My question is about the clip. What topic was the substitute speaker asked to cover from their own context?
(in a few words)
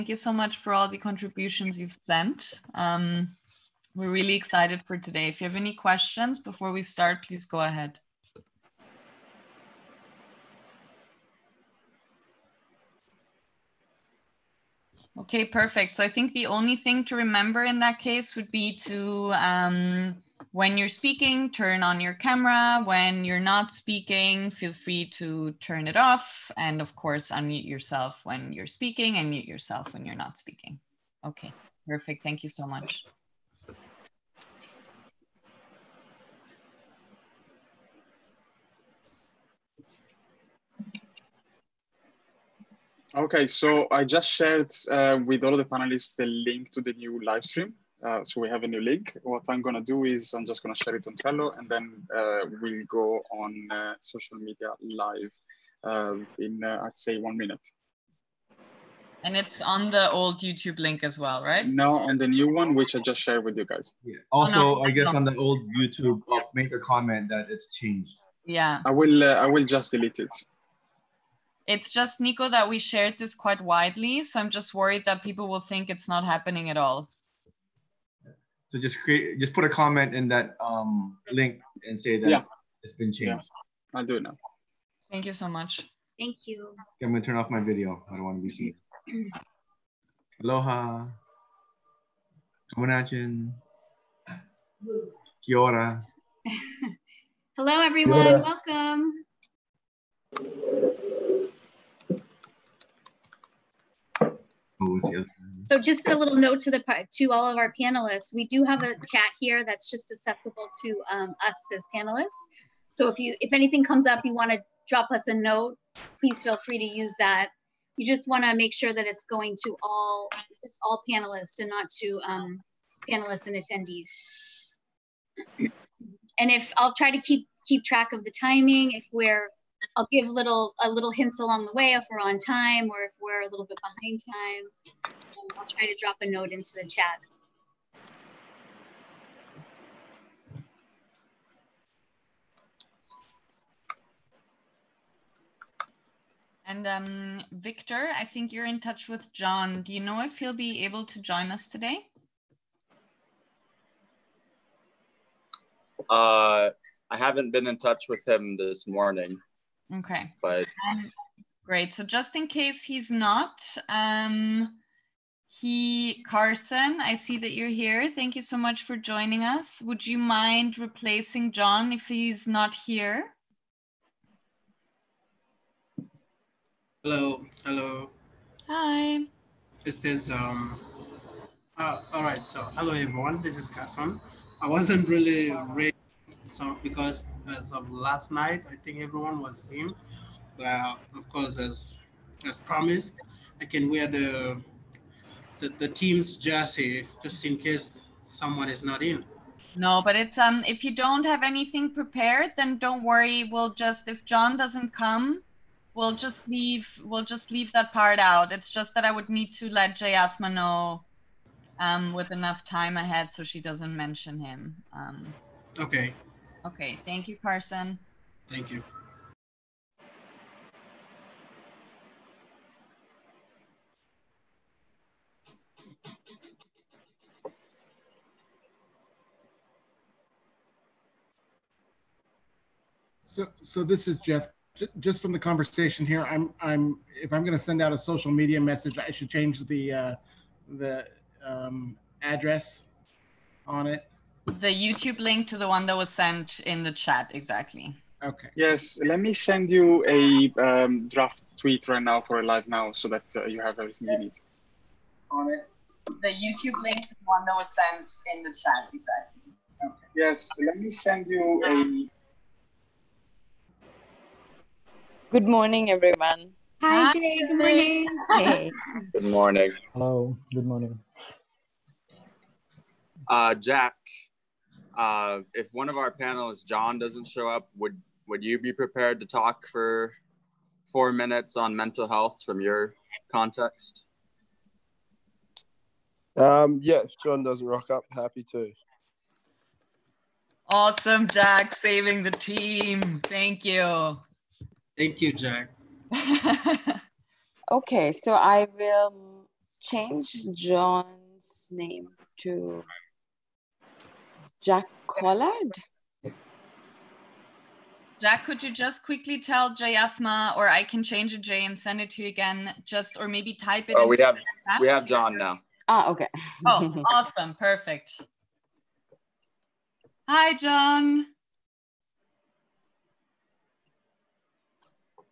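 Mental health.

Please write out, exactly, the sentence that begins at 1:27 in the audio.
I'm gonna turn off my video.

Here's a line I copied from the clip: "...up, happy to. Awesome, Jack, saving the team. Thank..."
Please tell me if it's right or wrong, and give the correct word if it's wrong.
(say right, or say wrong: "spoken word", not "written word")
right.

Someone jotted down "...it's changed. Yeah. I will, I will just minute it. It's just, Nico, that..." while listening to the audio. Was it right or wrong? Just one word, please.
wrong.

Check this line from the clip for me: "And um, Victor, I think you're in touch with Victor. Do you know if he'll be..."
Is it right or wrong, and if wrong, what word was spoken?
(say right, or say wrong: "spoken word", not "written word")
wrong: "John", not "Victor".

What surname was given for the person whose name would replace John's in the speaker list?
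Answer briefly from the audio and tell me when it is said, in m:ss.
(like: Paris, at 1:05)
Collard, at 5:05.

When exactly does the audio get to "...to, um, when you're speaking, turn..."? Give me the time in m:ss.
0:18.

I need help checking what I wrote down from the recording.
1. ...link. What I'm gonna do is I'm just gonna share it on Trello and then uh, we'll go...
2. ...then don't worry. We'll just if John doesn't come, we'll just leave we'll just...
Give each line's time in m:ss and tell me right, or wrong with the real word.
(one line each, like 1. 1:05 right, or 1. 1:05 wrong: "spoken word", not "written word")
1. 0:48 right
2. 3:22 right.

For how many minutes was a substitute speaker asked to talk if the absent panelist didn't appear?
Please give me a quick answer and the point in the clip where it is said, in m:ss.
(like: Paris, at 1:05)
4, at 4:40.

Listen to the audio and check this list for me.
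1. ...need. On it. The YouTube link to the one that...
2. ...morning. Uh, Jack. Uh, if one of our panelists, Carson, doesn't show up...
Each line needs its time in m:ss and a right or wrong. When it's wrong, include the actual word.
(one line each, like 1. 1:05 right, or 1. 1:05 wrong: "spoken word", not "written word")
1. 4:14 right
2. 4:30 wrong: "John", not "Carson".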